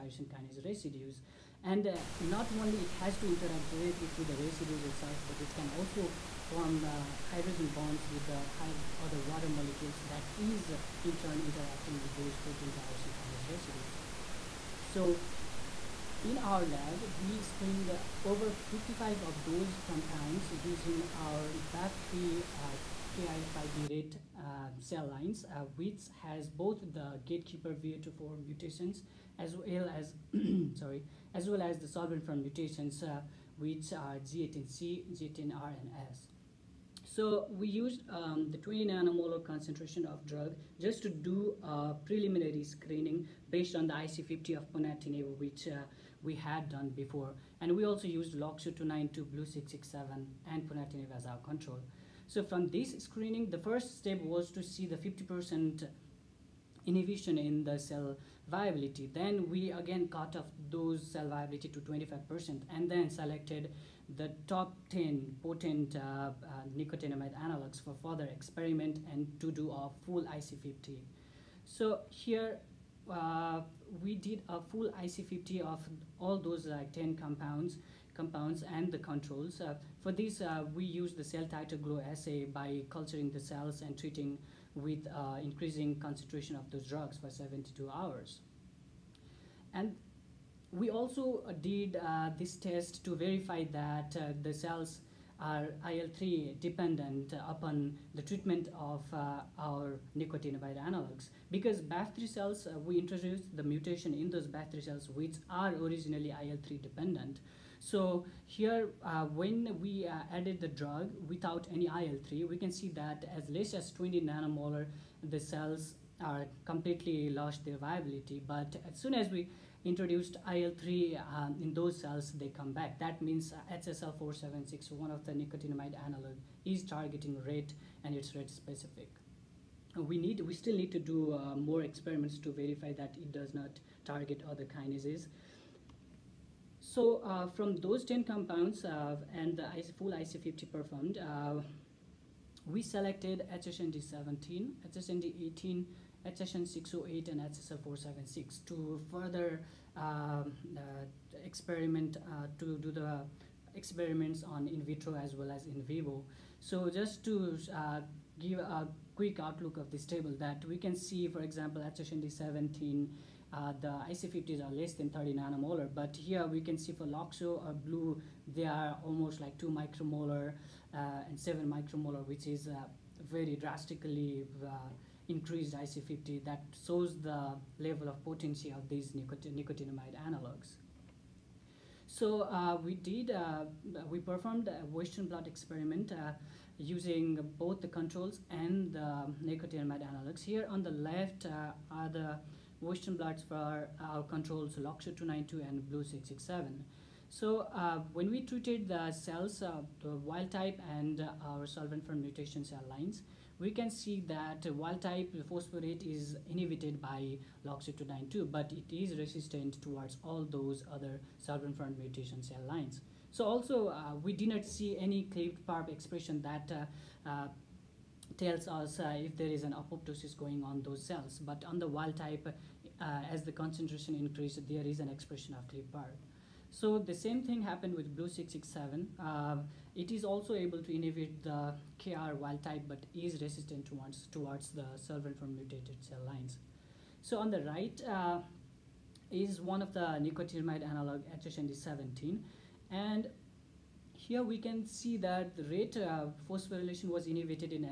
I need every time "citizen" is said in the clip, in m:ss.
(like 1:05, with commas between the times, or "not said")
not said.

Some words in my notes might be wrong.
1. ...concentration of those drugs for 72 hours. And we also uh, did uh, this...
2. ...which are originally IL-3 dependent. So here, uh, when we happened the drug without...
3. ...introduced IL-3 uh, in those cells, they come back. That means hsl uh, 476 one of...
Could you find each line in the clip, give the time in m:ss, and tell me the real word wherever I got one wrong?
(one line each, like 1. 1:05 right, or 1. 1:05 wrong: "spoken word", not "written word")
1. 1:25 right
2. 1:45 wrong: "added", not "happened"
3. 1:59 right.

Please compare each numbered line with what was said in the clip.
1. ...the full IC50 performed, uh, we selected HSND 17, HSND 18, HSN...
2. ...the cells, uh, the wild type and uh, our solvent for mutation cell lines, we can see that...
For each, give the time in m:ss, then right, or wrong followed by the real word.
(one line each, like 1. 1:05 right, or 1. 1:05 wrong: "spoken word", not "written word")
1. 2:19 right
2. 3:18 right.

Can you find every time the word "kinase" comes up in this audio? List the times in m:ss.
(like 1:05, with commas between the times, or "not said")
0:00, 0:13, 2:14.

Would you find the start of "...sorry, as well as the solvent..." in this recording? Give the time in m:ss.
0:30.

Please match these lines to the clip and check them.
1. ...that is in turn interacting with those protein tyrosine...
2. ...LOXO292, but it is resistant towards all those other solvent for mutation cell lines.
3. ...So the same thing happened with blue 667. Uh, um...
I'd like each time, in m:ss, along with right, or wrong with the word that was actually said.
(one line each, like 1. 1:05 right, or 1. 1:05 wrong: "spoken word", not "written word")
1. 0:10 right
2. 3:27 right
3. 3:46 right.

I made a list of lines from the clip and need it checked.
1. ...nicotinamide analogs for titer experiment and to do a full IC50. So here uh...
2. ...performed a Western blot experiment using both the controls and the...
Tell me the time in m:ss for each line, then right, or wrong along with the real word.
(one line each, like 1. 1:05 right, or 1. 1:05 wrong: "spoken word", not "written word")
1. 1:06 wrong: "further", not "titer"
2. 3:04 right.